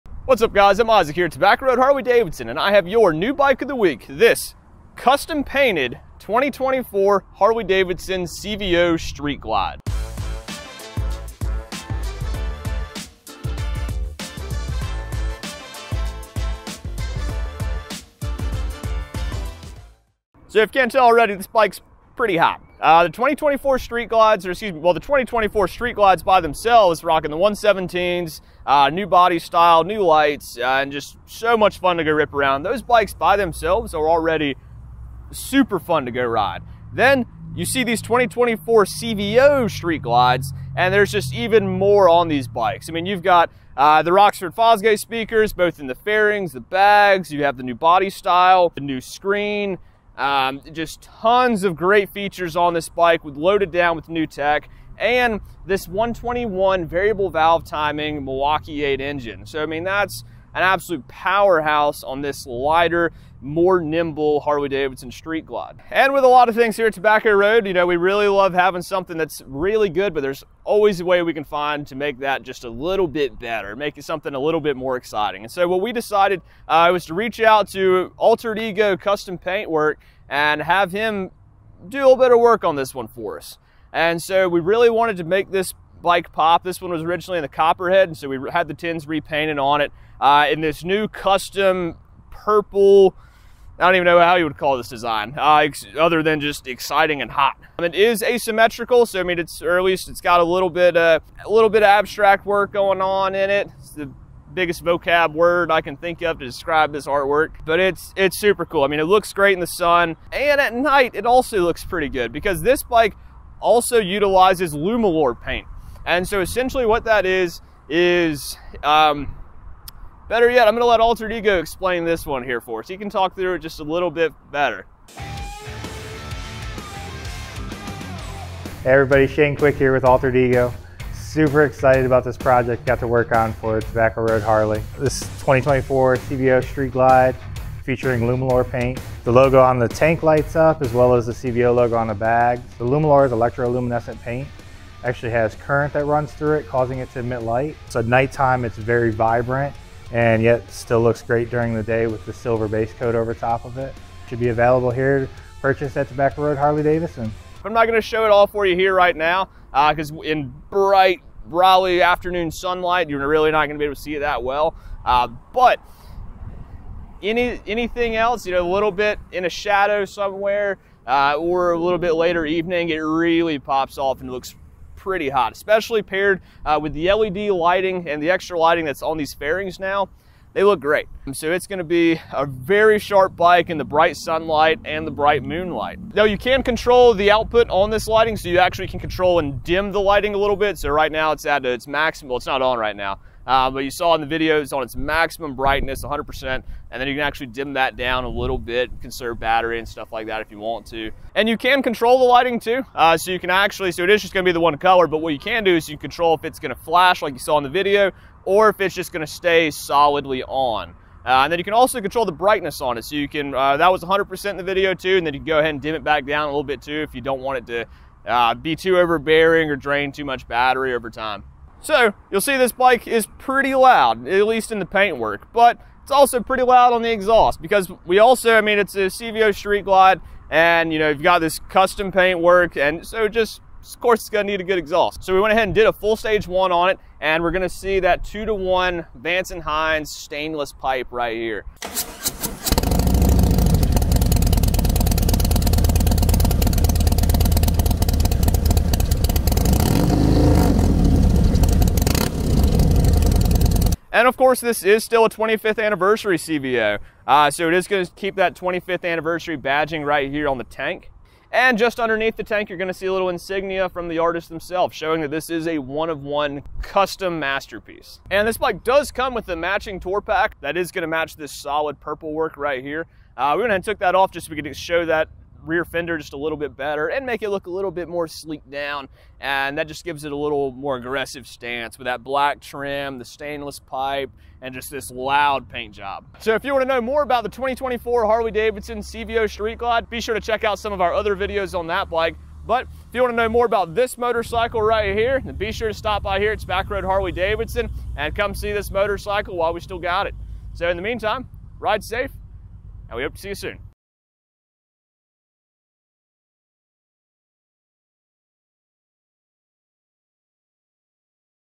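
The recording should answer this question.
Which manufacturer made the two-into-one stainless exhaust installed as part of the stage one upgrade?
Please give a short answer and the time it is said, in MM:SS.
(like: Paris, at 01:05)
Vance and Hines, at 03:59.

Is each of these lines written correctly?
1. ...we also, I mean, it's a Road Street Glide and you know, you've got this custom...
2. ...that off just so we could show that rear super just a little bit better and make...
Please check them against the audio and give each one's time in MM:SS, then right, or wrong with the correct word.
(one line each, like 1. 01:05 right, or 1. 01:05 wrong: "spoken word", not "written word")
1. 03:48 wrong: "CVO", not "Road"
2. 04:33 wrong: "fender", not "super".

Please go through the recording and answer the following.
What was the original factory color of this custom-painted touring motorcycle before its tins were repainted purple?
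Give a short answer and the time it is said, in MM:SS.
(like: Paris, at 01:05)
Copperhead, at 01:27.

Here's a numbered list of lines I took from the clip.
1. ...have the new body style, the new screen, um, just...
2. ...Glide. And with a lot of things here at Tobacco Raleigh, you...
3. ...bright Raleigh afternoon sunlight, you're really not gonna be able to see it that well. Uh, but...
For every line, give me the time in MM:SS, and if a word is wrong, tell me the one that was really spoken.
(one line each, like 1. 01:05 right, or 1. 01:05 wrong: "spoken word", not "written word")
1. 00:47 right
2. 01:05 wrong: "Road", not "Raleigh"
3. 02:40 right.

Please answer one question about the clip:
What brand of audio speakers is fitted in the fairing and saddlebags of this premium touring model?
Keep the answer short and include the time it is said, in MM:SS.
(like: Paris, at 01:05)
Rockford Fosgate, at 00:44.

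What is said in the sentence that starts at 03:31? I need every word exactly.
Uh, and then you can also control the brightness on it.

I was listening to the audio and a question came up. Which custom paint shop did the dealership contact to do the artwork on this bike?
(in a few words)
Altered Ego Custom Paintwork.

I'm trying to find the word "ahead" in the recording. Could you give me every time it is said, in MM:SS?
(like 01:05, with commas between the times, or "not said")
03:35, 03:55, 04:33.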